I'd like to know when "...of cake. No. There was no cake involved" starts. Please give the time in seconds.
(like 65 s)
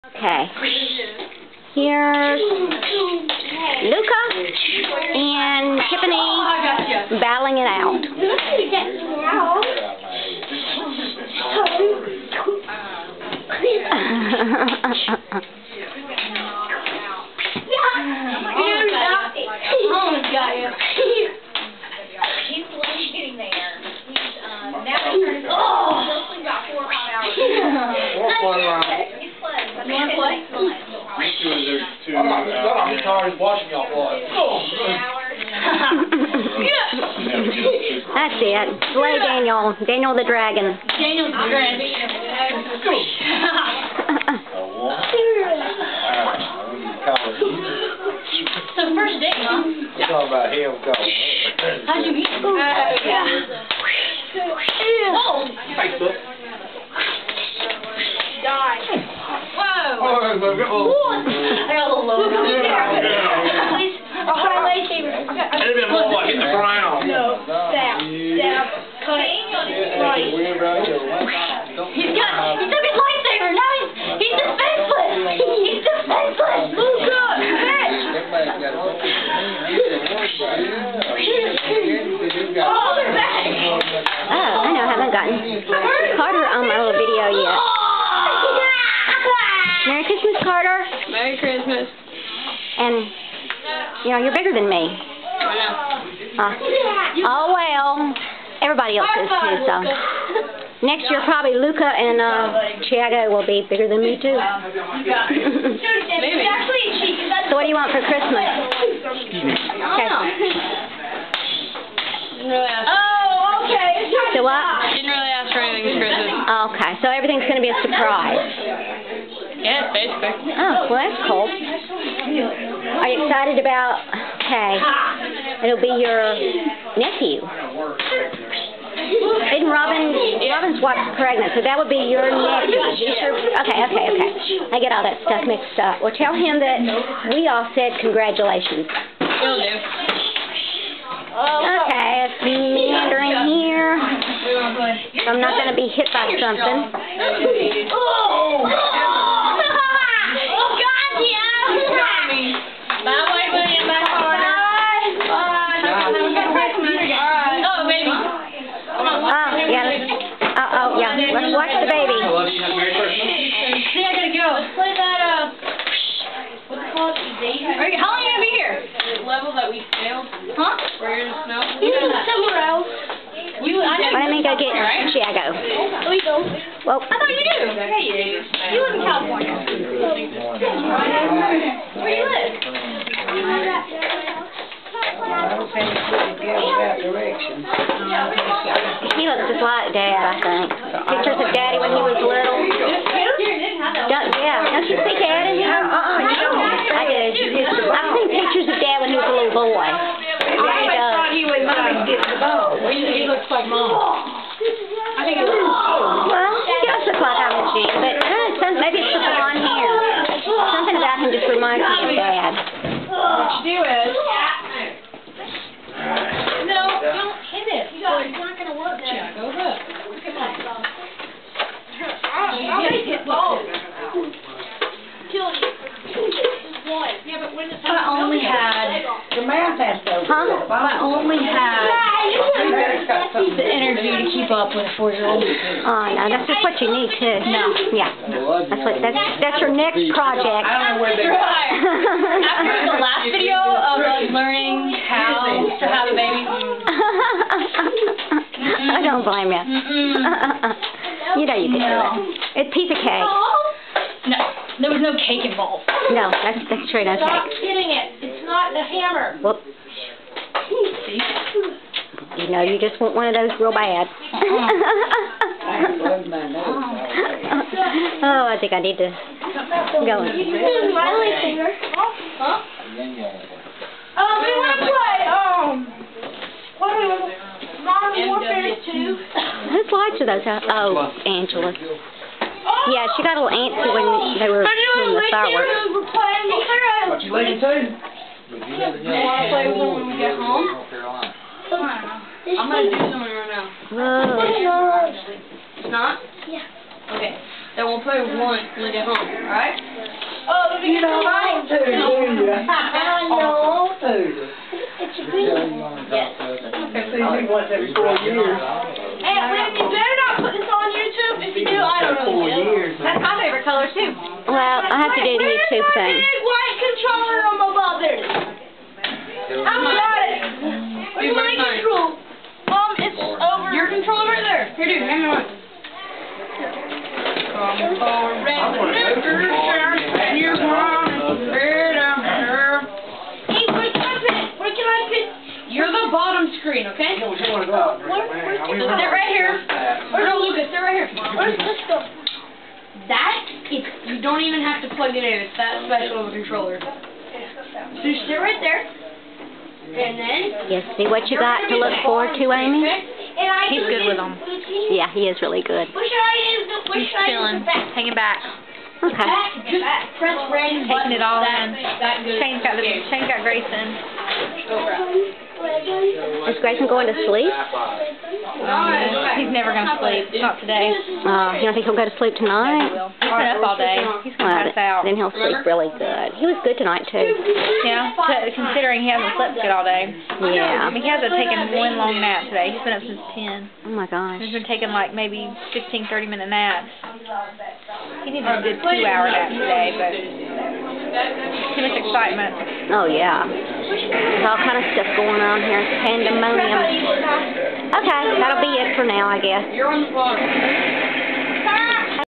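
252 s.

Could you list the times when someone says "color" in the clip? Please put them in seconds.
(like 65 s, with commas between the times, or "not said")
313 s.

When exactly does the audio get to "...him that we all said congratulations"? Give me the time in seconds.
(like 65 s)
136 s.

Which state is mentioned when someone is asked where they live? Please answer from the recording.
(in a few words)
California.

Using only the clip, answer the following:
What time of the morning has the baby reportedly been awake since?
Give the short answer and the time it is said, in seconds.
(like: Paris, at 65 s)
10, at 383 s.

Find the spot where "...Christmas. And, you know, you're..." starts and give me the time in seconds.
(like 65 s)
91 s.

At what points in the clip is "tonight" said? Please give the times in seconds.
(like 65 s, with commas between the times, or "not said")
372 s, 376 s.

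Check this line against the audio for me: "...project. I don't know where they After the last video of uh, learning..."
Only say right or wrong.
right.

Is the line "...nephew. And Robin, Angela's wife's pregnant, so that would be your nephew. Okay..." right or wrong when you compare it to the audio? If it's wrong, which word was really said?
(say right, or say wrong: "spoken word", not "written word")
wrong: "Robin", not "Angela".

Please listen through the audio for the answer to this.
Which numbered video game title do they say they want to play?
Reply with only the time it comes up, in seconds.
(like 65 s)
277 s.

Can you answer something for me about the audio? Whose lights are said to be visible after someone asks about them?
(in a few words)
Angela.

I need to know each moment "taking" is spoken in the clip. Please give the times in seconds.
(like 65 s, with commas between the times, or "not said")
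361 s, 384 s.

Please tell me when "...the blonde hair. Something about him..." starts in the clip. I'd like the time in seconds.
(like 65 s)
209 s.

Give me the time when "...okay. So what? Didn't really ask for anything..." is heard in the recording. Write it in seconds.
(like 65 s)
113 s.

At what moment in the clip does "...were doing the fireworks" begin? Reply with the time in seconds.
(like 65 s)
284 s.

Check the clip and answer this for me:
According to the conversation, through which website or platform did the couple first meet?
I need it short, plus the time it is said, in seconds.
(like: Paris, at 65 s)
Facebook, at 55 s.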